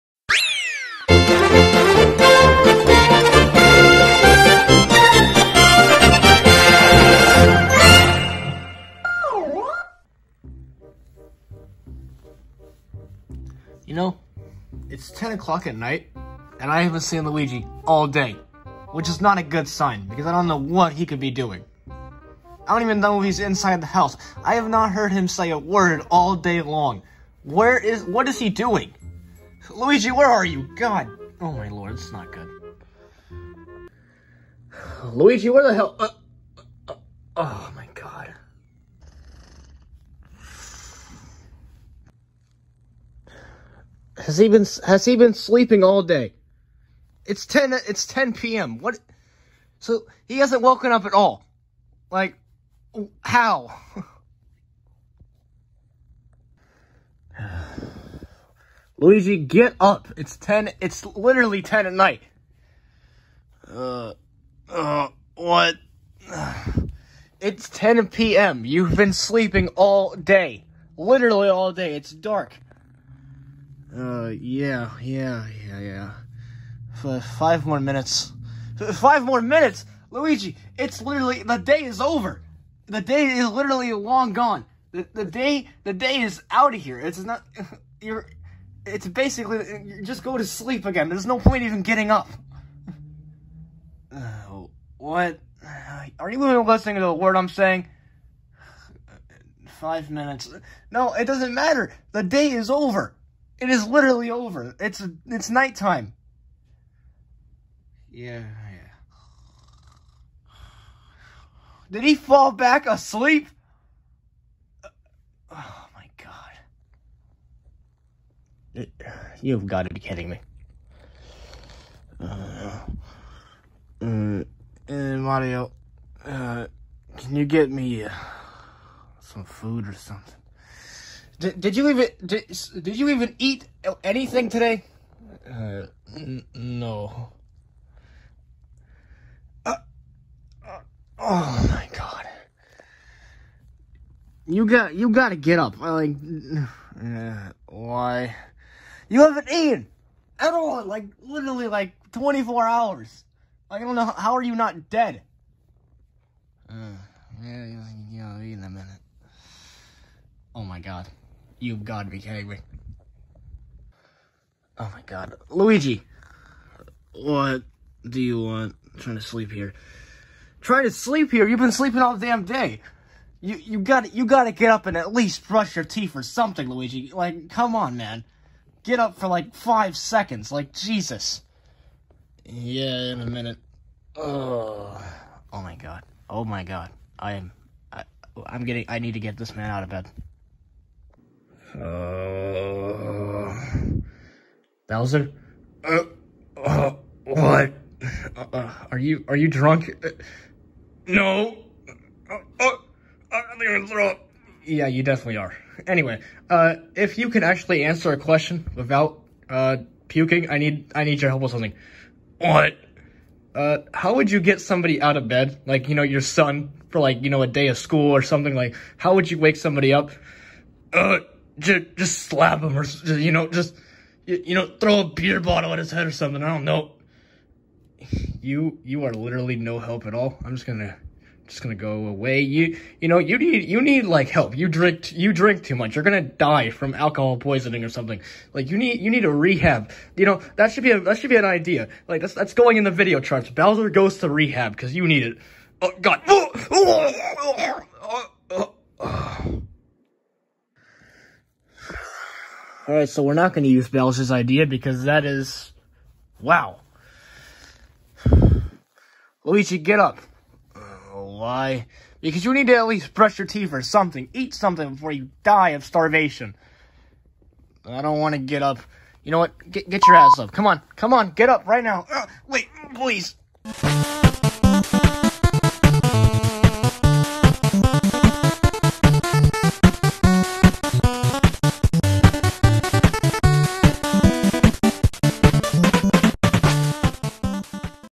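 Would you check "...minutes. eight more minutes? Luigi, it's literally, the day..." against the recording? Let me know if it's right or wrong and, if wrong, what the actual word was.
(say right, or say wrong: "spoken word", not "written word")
wrong: "five", not "eight".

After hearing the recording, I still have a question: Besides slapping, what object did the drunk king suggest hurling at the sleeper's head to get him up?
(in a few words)
a beer bottle.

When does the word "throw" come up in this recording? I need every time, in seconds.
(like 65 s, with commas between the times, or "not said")
203 s, 224 s.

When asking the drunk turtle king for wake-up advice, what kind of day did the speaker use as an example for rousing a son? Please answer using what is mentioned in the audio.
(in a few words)
a day of school.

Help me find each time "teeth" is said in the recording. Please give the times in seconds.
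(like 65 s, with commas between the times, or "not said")
175 s, 263 s.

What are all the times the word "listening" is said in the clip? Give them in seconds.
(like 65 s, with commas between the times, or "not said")
96 s.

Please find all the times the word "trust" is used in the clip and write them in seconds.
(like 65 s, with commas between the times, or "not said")
not said.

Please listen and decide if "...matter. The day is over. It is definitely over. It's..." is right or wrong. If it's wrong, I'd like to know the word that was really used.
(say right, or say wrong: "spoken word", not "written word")
wrong: "literally", not "definitely".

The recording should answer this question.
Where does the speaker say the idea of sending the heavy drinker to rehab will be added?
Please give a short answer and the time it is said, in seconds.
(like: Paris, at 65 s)
the video charts, at 242 s.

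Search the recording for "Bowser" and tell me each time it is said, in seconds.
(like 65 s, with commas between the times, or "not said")
194 s, 243 s, 253 s.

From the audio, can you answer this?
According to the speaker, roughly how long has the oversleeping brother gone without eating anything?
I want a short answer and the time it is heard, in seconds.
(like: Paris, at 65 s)
24 hours, at 152 s.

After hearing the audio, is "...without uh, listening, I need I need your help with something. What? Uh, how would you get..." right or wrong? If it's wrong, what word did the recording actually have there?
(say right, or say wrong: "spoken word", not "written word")
wrong: "puking", not "listening".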